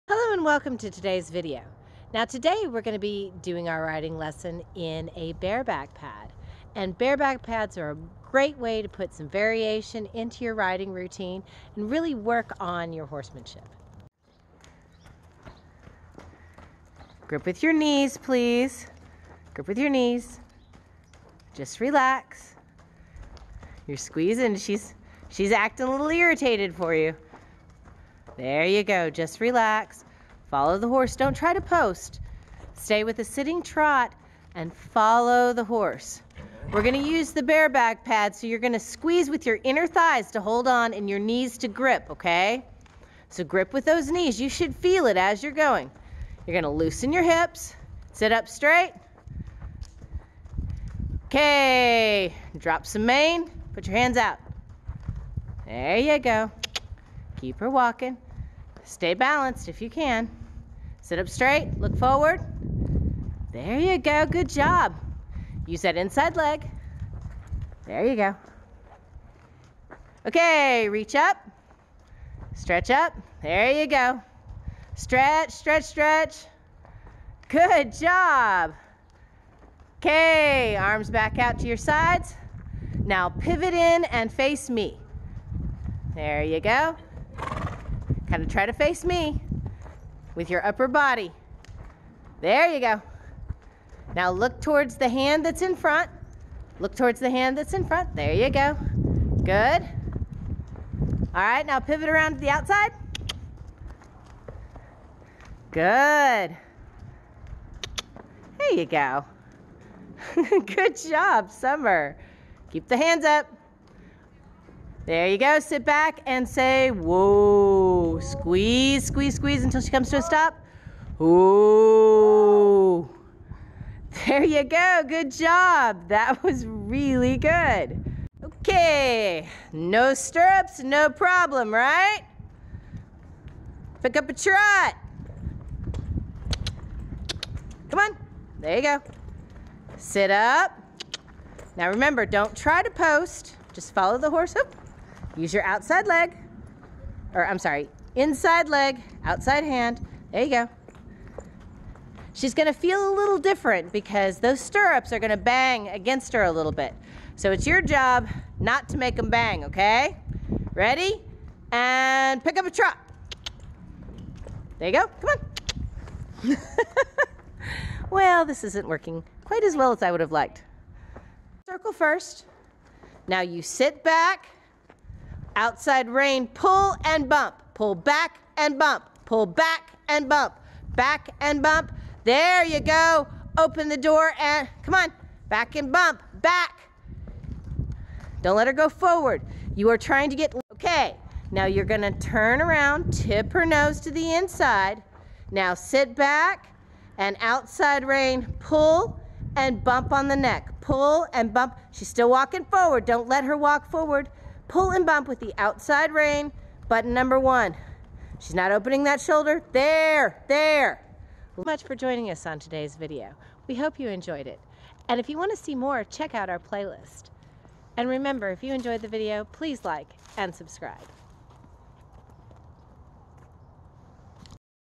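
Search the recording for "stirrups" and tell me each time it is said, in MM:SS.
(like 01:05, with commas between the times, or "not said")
02:10, 02:34.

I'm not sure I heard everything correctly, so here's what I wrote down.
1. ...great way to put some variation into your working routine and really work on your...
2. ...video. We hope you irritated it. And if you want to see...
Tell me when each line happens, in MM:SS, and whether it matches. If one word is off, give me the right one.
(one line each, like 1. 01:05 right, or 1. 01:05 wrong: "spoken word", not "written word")
1. 00:08 wrong: "riding", not "working"
2. 03:32 wrong: "enjoyed", not "irritated".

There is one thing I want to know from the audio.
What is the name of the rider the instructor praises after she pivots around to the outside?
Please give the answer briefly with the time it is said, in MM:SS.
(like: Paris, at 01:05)
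Summer, at 01:51.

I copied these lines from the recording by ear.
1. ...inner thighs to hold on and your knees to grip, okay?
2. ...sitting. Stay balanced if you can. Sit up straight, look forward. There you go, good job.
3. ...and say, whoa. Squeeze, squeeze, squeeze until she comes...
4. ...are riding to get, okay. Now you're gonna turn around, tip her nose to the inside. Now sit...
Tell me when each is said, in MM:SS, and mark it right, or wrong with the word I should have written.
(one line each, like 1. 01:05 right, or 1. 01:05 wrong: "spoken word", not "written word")
1. 00:39 right
2. 00:57 wrong: "walking", not "sitting"
3. 01:56 right
4. 03:09 wrong: "trying", not "riding".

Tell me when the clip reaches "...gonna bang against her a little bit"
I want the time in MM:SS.
02:35.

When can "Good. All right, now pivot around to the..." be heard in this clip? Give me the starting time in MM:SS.
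01:39.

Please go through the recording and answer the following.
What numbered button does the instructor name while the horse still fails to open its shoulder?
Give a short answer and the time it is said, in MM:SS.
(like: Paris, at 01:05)
Button number one, at 03:26.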